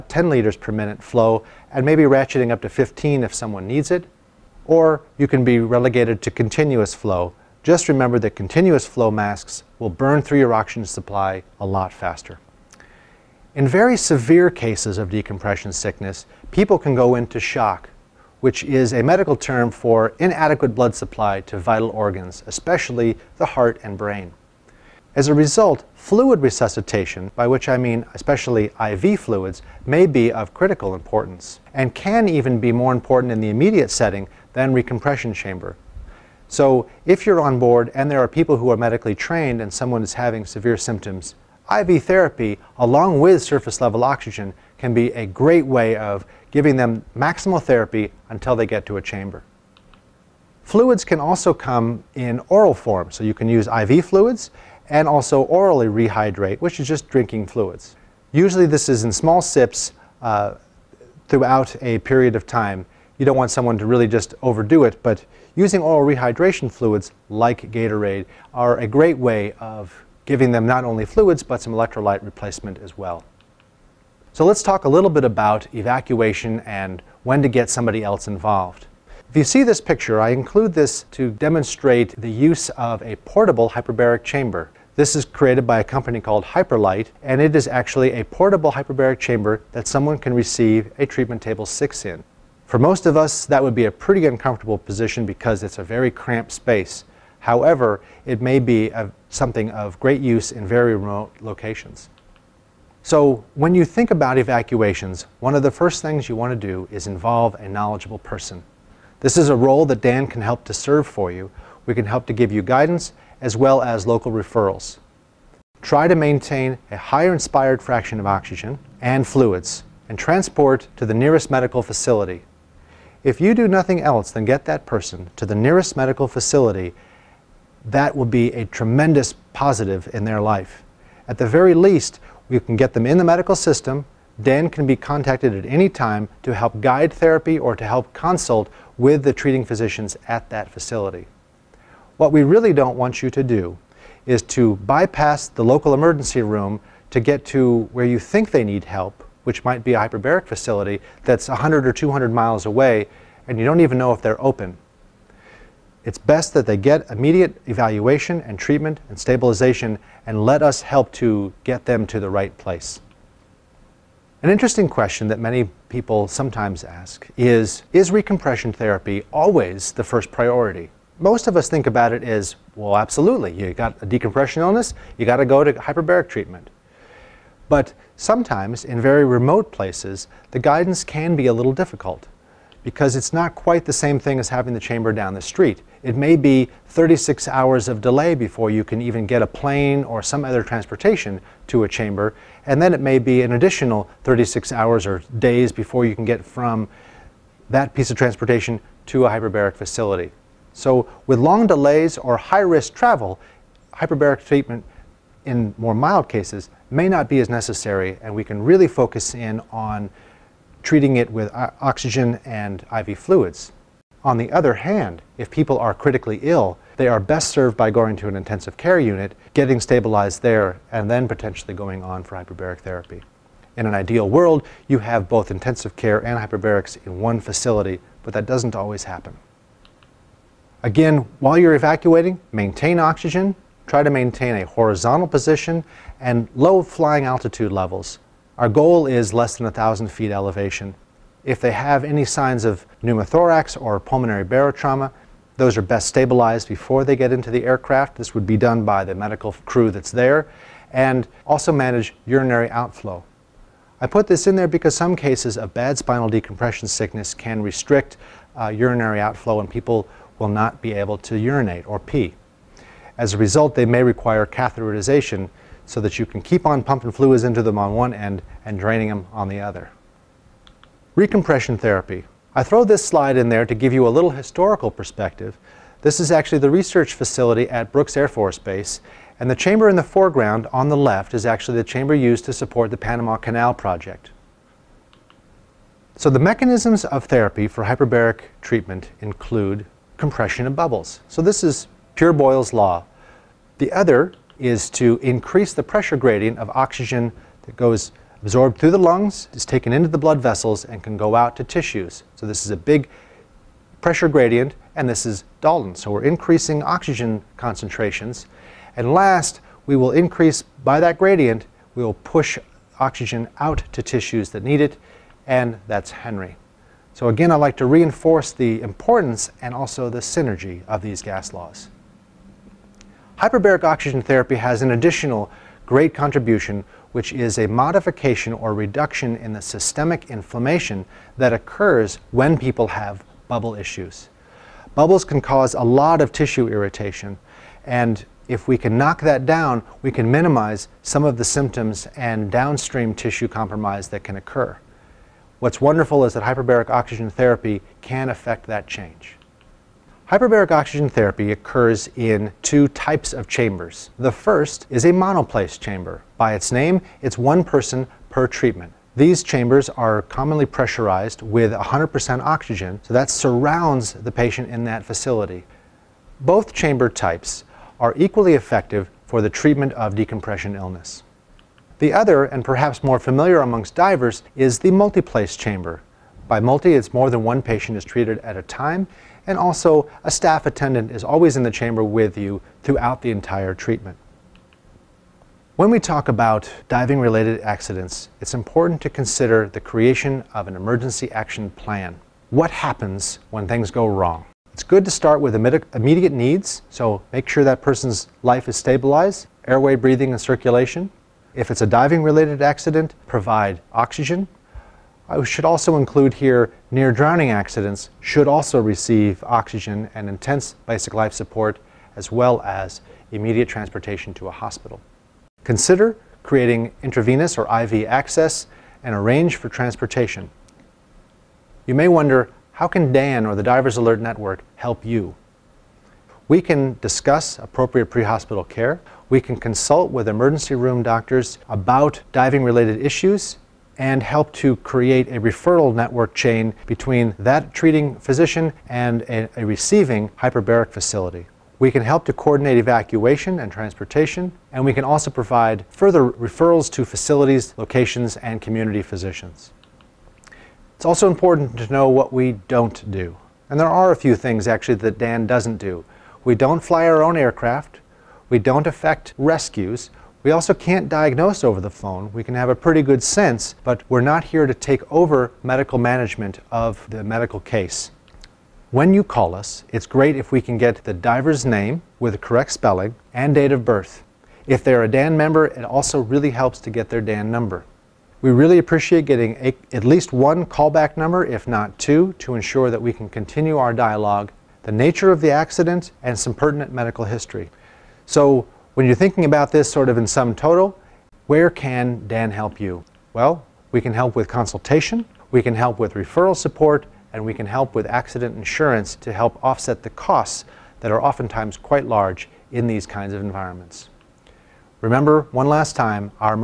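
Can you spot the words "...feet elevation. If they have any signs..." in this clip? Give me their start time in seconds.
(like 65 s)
240 s.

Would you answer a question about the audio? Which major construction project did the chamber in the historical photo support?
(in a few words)
Panama Canal.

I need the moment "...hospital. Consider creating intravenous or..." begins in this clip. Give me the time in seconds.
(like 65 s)
414 s.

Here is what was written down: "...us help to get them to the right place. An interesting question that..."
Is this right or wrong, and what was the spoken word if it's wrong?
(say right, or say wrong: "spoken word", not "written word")
right.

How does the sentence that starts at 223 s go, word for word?
In an ideal world, you have both intensive care and hyperbarics in one facility, but that doesn't always happen.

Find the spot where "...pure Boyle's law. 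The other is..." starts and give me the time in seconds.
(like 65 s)
292 s.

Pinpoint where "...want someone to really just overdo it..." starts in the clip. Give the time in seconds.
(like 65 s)
63 s.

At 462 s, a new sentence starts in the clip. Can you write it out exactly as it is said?
We can have a pretty good sense, but we're not here to take over medical management of the medical case.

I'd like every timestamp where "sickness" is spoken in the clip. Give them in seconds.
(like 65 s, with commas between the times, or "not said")
15 s, 256 s.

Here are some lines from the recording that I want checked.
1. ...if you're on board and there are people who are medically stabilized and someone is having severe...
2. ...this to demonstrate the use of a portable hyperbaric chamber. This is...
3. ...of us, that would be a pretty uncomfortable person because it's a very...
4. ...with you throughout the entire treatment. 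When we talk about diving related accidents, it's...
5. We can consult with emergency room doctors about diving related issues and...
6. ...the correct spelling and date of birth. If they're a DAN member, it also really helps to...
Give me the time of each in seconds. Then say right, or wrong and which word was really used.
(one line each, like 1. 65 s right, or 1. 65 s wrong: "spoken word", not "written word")
1. 37 s wrong: "trained", not "stabilized"
2. 80 s right
3. 93 s wrong: "position", not "person"
4. 382 s right
5. 429 s right
6. 472 s right.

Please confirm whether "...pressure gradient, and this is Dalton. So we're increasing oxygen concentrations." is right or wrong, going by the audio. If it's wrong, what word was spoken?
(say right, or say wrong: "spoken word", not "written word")
right.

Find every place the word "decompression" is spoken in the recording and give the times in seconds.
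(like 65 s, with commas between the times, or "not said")
15 s, 174 s, 256 s, 370 s.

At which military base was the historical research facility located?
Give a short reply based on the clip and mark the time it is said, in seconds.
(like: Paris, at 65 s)
Brooks Air Force Base, at 277 s.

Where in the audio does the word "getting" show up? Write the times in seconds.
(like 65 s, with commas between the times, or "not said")
219 s, 479 s.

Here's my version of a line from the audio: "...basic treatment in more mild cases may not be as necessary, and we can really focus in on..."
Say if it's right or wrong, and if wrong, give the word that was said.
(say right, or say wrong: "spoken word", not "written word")
wrong: "hyperbaric", not "basic".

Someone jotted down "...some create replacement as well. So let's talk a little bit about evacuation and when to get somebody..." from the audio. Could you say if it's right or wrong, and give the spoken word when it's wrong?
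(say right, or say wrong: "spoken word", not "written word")
wrong: "electrolyte", not "create".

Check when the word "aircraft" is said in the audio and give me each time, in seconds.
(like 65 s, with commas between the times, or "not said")
247 s, 457 s.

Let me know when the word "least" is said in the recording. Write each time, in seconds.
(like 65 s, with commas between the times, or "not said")
131 s, 480 s.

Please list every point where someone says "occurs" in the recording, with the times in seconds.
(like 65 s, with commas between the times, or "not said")
331 s, 344 s, 351 s.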